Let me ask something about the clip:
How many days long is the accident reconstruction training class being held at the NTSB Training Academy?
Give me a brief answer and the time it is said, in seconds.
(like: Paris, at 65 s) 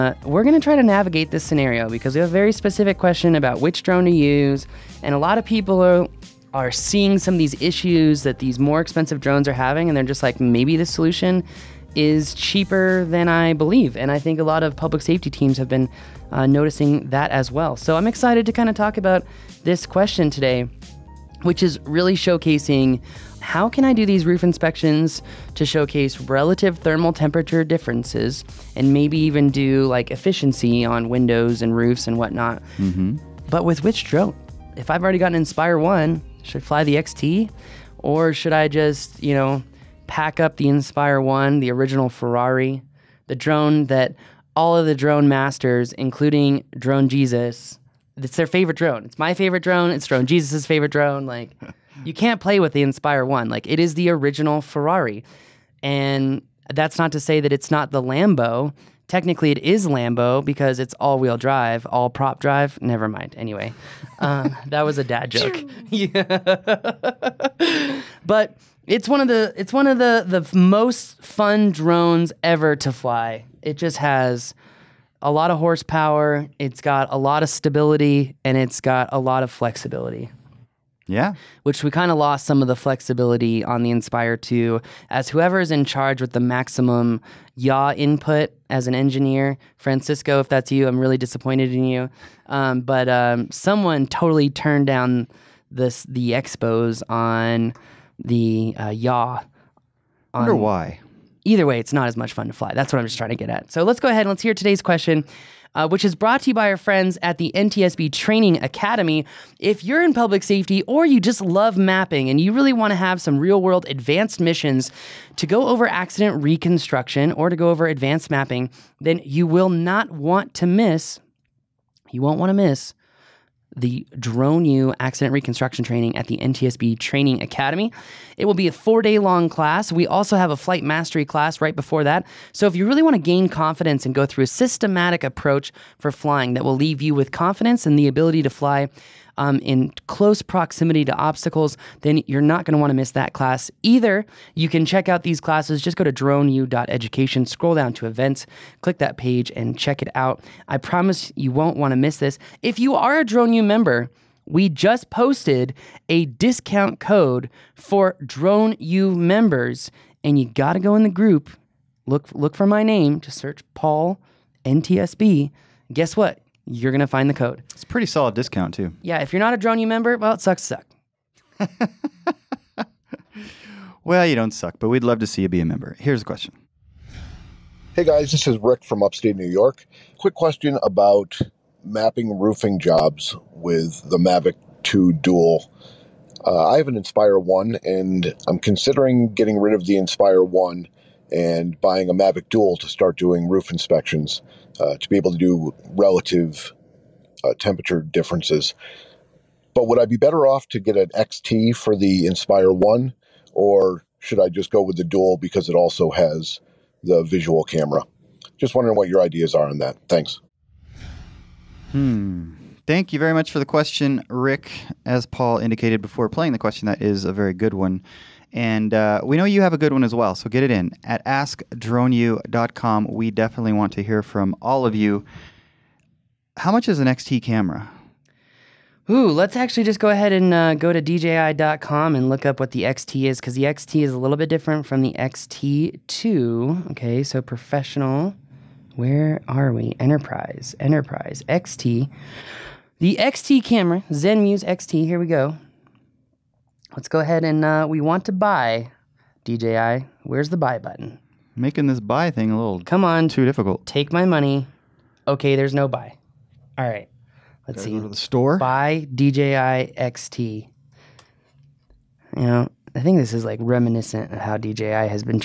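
4, at 128 s.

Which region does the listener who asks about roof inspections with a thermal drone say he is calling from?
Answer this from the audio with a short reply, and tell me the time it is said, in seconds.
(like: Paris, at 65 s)
upstate New York, at 179 s.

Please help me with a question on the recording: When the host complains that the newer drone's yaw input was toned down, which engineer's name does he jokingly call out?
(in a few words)
Francisco.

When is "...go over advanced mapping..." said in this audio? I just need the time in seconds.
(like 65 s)
117 s.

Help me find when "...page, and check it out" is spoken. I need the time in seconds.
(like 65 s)
149 s.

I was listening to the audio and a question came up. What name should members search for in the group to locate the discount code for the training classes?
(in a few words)
Paul NTSB.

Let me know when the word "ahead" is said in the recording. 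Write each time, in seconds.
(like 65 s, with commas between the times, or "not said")
104 s, 230 s, 247 s.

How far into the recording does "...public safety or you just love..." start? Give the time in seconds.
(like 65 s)
110 s.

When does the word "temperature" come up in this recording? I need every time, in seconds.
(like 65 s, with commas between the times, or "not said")
27 s, 197 s.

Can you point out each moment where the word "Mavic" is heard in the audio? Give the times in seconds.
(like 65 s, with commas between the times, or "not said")
184 s, 192 s.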